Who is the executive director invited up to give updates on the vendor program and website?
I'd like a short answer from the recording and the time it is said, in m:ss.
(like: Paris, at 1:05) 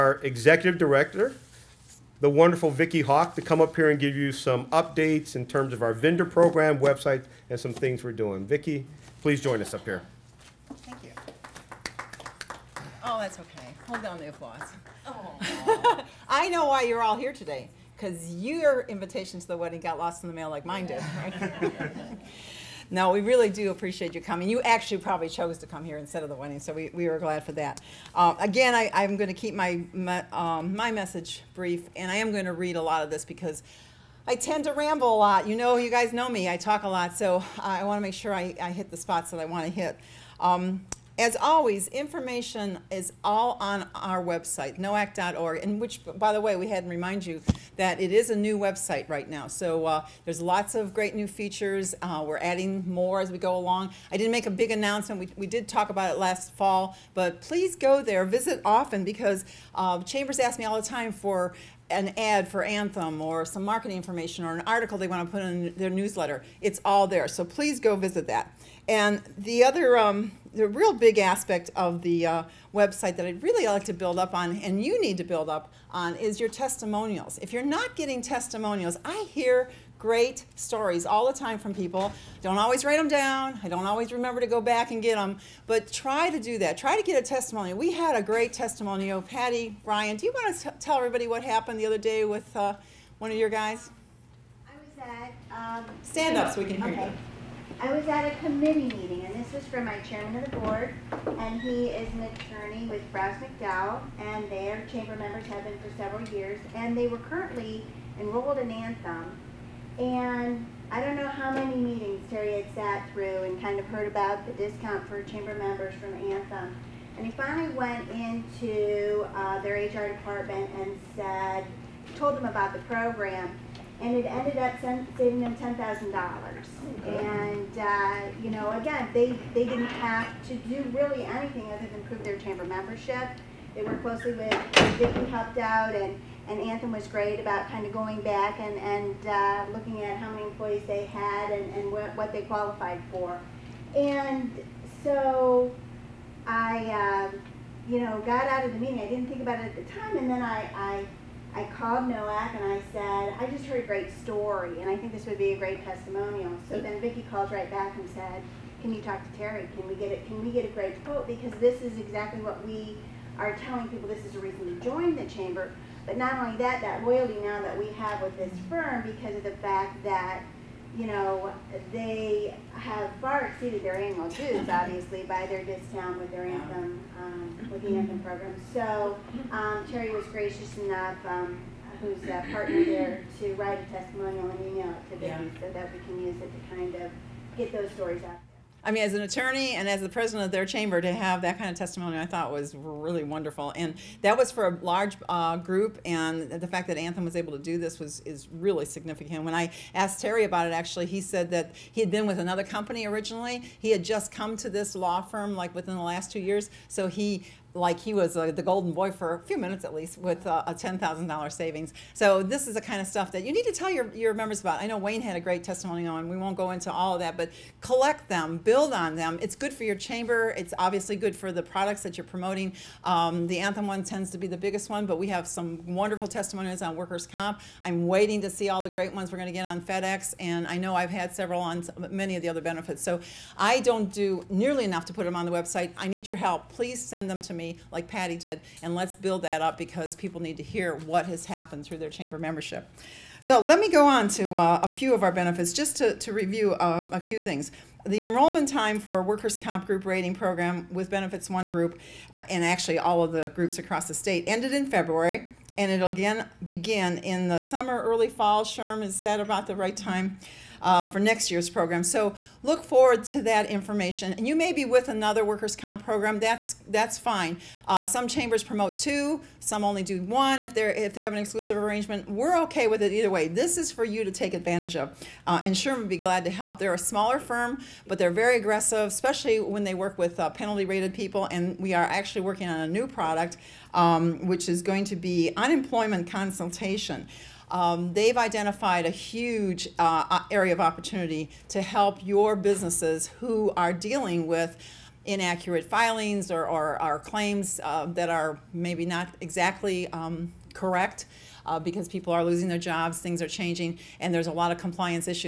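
Vicky Hawke, at 0:02.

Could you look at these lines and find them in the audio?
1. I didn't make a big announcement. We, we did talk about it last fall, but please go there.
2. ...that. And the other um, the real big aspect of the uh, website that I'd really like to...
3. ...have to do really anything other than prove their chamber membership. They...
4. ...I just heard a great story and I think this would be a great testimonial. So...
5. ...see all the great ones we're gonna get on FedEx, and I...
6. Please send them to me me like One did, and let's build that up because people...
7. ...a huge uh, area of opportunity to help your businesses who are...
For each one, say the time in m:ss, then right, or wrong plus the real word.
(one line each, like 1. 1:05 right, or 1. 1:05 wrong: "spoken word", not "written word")
1. 0:54 right
2. 1:08 right
3. 2:09 right
4. 2:33 right
5. 3:48 right
6. 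3:56 wrong: "Patty", not "One"
7. 4:49 right.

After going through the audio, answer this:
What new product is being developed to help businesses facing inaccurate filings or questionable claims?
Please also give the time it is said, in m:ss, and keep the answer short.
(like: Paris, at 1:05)
unemployment consultation, at 4:45.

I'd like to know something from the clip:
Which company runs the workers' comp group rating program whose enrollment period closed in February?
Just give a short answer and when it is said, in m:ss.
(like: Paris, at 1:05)
Benefits One Group, at 4:11.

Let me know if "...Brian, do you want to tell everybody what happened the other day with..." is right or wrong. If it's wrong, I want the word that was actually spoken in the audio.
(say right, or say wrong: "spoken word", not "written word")
right.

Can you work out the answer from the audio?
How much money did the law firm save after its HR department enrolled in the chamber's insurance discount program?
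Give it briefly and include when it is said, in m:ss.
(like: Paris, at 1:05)
$10,000, at 2:05.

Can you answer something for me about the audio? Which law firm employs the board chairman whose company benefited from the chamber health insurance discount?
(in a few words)
Brouse McDowell.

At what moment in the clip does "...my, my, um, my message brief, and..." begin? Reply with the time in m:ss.
0:29.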